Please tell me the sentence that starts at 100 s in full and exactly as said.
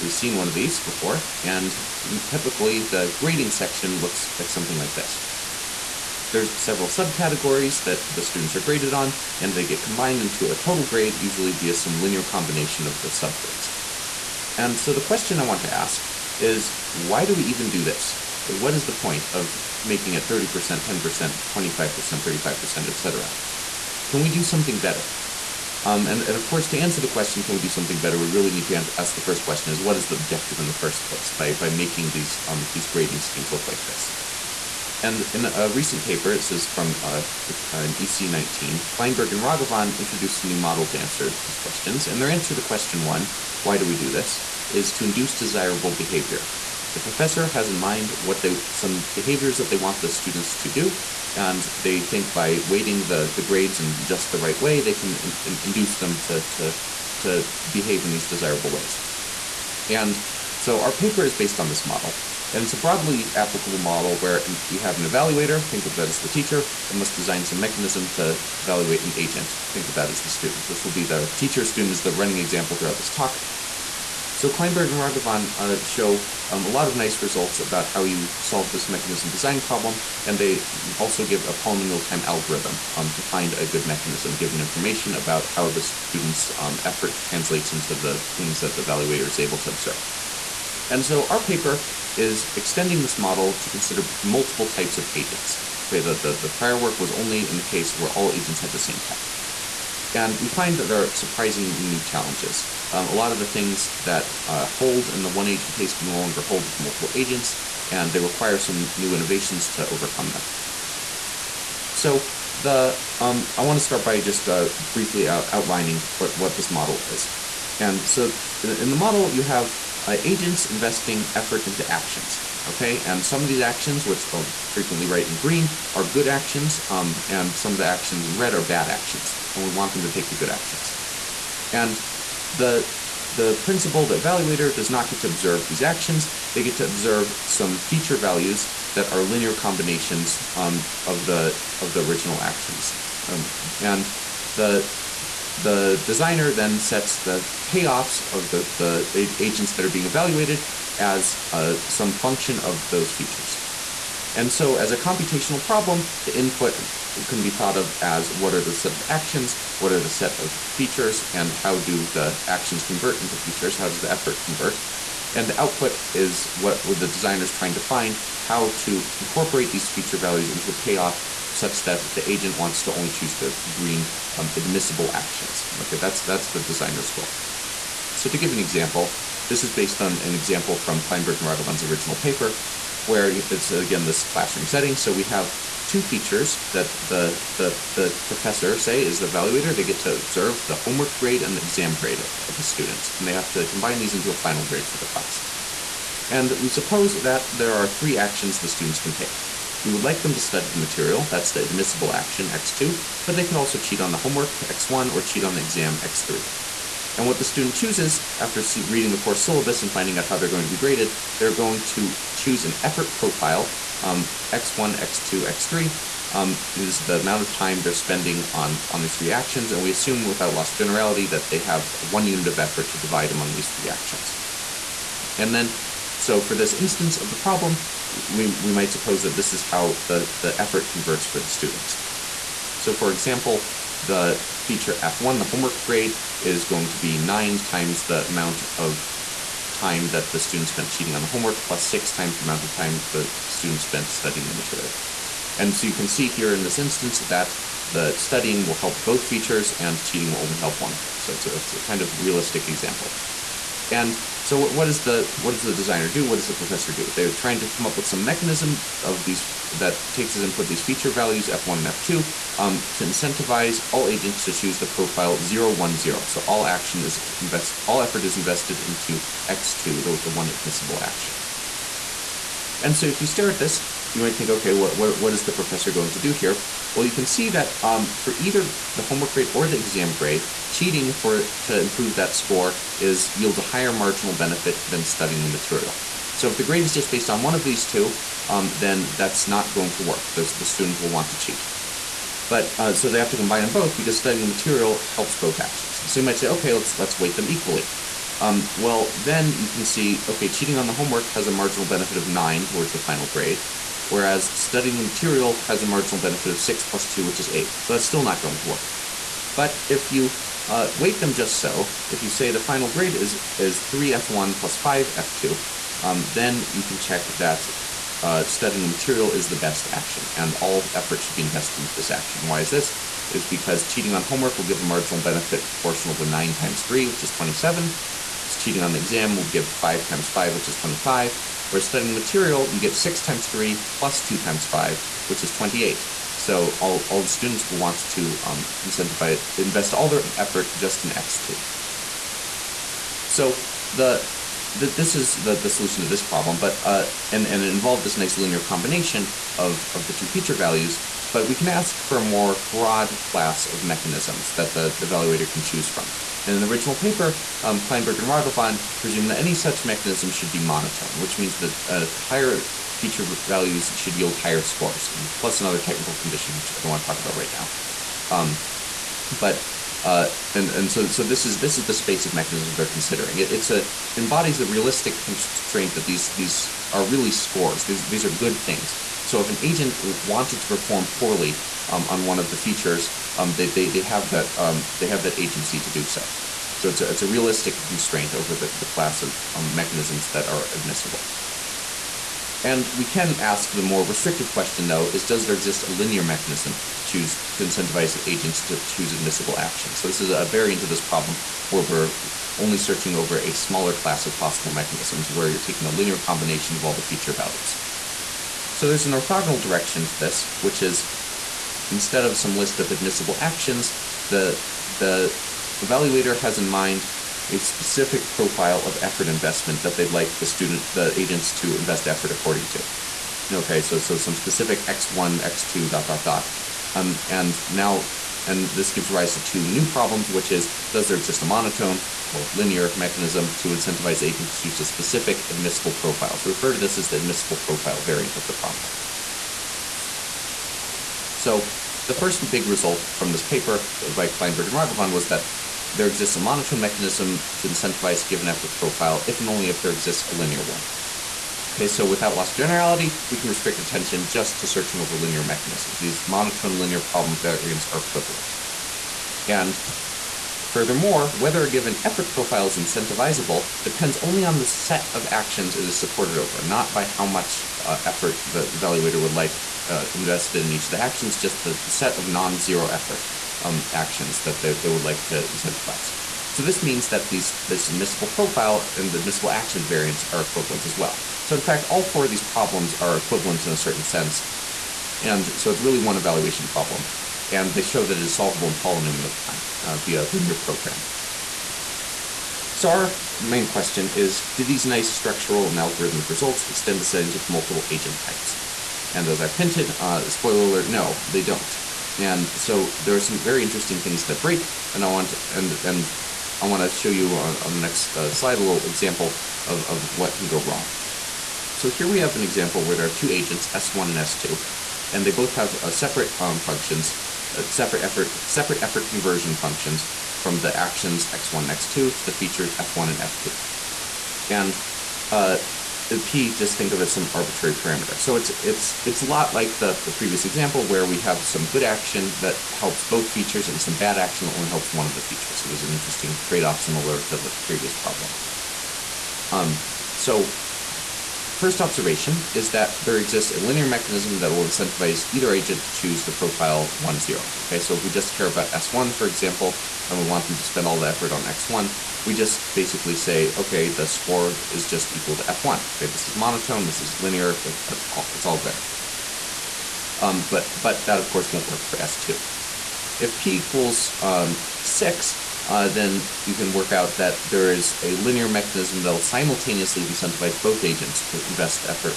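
And we find that there are surprising new challenges.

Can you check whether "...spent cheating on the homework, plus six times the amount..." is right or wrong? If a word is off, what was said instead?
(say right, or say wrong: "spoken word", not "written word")
right.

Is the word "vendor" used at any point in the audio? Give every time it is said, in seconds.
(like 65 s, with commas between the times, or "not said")
not said.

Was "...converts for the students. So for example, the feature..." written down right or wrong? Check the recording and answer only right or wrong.
right.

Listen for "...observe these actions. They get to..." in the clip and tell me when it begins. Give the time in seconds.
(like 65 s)
135 s.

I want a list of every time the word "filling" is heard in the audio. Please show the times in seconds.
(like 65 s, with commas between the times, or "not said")
not said.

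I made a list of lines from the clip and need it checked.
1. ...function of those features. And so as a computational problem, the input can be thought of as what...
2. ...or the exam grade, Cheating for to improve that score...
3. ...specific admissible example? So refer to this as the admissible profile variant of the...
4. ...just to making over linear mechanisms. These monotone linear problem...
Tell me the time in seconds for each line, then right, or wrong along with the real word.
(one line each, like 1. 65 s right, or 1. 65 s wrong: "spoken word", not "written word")
1. 152 s right
2. 279 s right
3. 434 s wrong: "profile", not "example"
4. 454 s wrong: "searching", not "making".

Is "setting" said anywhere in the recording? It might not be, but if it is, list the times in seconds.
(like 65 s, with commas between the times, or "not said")
184 s, 497 s.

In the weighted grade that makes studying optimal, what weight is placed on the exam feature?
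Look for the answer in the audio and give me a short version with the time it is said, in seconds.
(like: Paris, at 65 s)
5, at 314 s.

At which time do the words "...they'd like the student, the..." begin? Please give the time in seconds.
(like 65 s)
419 s.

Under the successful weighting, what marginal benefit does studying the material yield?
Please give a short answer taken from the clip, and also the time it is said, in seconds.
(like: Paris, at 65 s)
28, at 335 s.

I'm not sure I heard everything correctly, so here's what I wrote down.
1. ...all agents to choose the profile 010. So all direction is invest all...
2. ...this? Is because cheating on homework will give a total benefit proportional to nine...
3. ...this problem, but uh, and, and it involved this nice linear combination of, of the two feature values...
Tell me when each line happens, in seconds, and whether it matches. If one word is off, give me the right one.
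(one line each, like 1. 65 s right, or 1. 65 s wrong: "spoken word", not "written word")
1. 263 s wrong: "action", not "direction"
2. 322 s wrong: "marginal", not "total"
3. 346 s right.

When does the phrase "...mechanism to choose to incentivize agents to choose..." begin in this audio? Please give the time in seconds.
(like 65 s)
396 s.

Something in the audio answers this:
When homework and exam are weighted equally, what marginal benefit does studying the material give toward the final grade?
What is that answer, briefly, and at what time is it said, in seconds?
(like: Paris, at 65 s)
8, at 307 s.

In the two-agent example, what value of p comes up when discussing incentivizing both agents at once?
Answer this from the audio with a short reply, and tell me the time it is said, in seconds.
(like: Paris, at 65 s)
6, at 564 s.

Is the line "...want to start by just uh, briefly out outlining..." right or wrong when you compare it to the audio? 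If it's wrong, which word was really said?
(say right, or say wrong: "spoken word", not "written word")
right.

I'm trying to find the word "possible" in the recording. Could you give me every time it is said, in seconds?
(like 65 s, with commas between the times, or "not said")
404 s.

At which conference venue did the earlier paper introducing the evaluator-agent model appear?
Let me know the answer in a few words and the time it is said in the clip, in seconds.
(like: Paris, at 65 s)
EC19, at 38 s.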